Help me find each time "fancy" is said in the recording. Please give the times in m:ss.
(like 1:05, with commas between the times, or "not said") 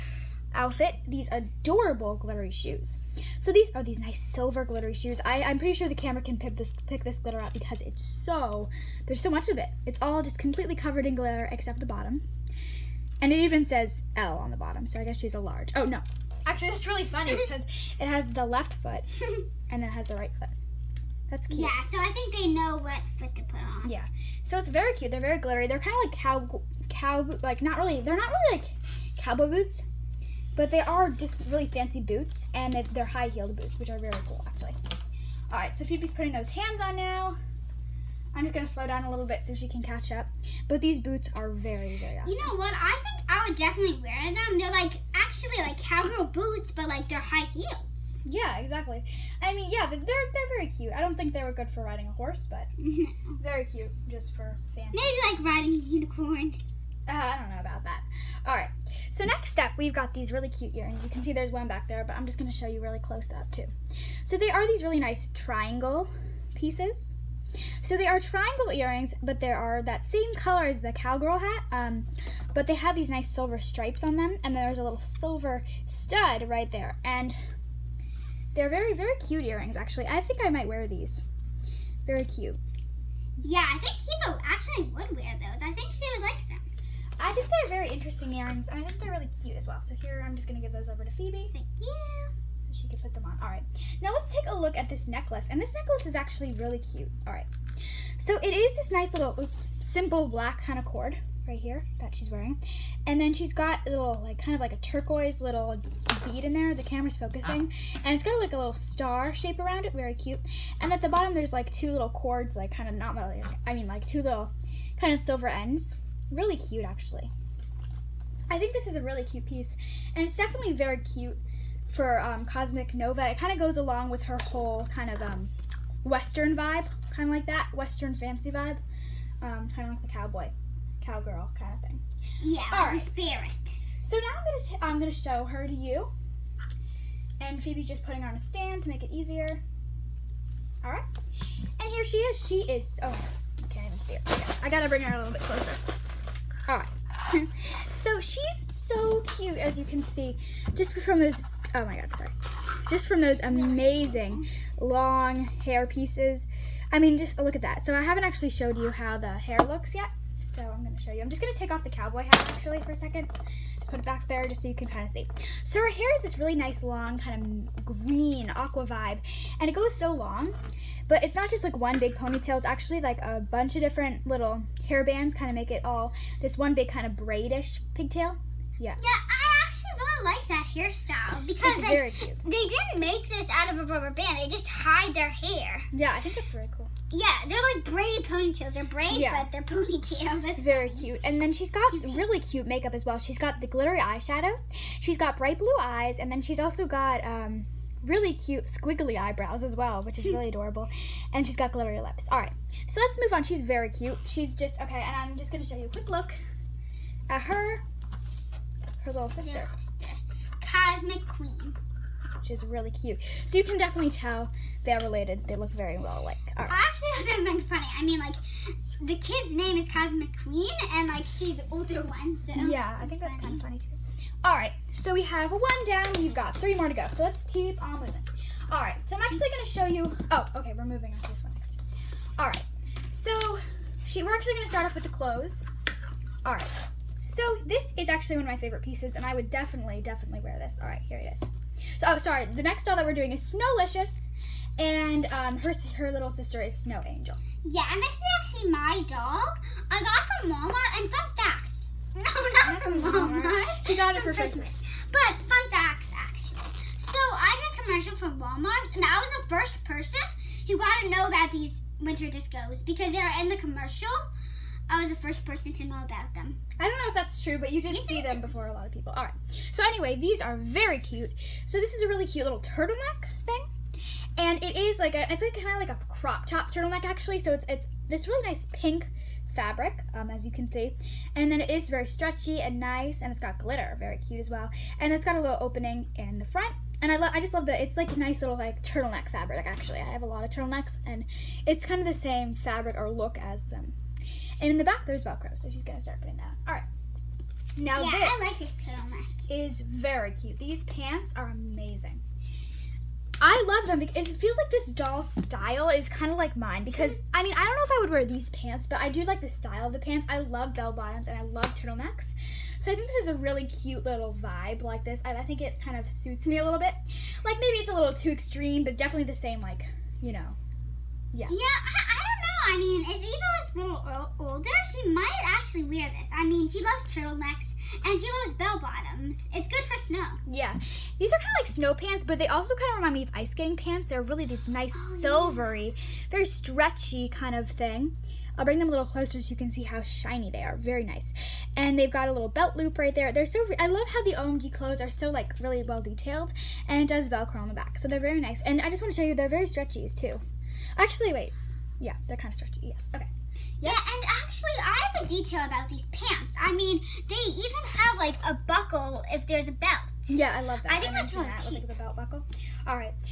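0:31, 2:08.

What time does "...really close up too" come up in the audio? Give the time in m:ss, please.
1:02.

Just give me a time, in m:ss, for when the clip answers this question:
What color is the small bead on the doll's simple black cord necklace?
1:44.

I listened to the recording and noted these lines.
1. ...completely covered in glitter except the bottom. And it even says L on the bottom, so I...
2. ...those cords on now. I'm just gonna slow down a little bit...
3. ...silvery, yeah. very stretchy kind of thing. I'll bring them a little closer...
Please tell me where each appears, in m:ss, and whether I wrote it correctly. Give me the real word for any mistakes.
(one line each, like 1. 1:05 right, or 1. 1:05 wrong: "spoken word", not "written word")
1. 0:10 right
2. 0:36 wrong: "hands", not "cords"
3. 5:35 right.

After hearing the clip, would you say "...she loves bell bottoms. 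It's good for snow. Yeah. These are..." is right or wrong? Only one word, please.
right.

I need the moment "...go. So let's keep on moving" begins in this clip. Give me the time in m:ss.
3:46.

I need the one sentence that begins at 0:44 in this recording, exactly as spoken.
They're like actually like cowgirl boots, but like they're high heels.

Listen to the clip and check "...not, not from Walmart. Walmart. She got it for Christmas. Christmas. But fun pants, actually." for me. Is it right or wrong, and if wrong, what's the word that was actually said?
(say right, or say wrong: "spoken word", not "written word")
wrong: "facts", not "pants".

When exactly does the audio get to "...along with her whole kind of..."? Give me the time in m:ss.
2:03.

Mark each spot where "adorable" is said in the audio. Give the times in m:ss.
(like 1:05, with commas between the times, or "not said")
0:01, 3:20.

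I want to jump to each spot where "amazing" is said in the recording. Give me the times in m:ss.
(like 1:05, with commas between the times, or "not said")
2:33, 5:01.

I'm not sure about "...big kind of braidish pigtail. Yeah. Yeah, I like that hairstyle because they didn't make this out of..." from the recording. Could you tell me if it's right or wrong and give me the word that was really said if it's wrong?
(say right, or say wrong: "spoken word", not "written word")
right.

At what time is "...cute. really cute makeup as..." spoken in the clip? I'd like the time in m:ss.
3:11.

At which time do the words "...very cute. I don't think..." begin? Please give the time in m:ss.
0:50.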